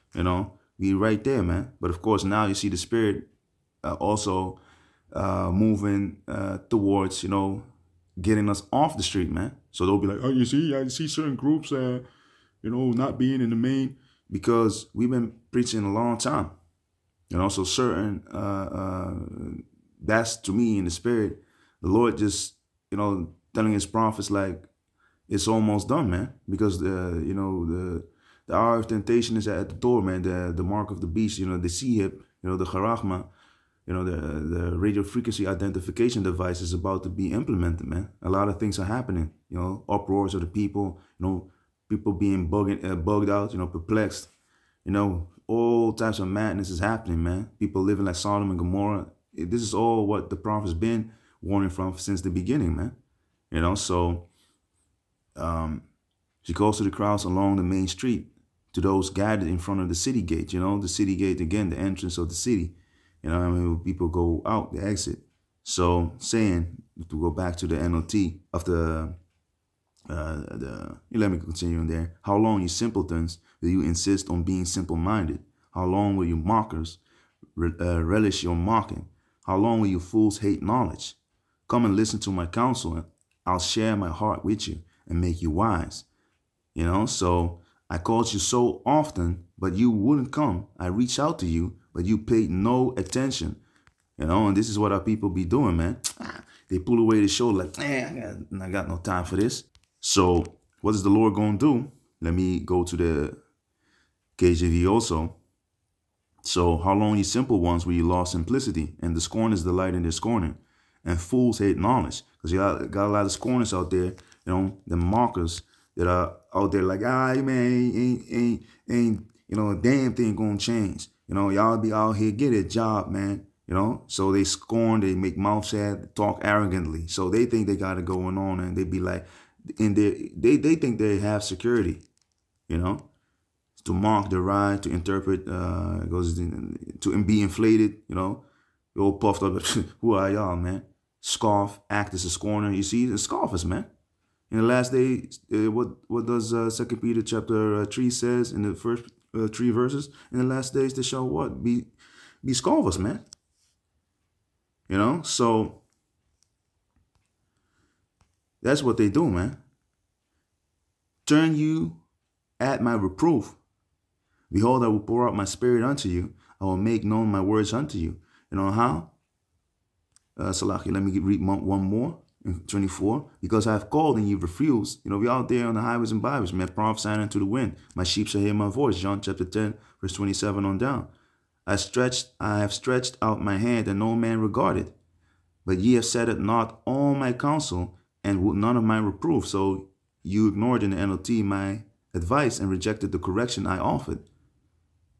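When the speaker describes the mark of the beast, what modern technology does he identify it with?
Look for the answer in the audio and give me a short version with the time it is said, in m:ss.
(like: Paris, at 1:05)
radio frequency identification device, at 0:34.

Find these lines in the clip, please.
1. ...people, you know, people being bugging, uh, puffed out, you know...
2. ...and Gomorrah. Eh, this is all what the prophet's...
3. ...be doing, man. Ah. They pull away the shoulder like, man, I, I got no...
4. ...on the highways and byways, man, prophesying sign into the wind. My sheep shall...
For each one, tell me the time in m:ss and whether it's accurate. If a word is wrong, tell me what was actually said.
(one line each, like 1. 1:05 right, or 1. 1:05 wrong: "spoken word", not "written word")
1. 0:40 wrong: "bugged", not "puffed"
2. 0:48 right
3. 1:35 right
4. 2:55 right.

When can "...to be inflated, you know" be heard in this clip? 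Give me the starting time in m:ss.
2:16.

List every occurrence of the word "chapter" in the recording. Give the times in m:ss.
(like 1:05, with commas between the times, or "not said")
2:27, 2:59.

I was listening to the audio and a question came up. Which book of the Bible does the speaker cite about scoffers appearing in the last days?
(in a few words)
Second Peter.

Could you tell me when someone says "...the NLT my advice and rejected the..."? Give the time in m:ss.
3:10.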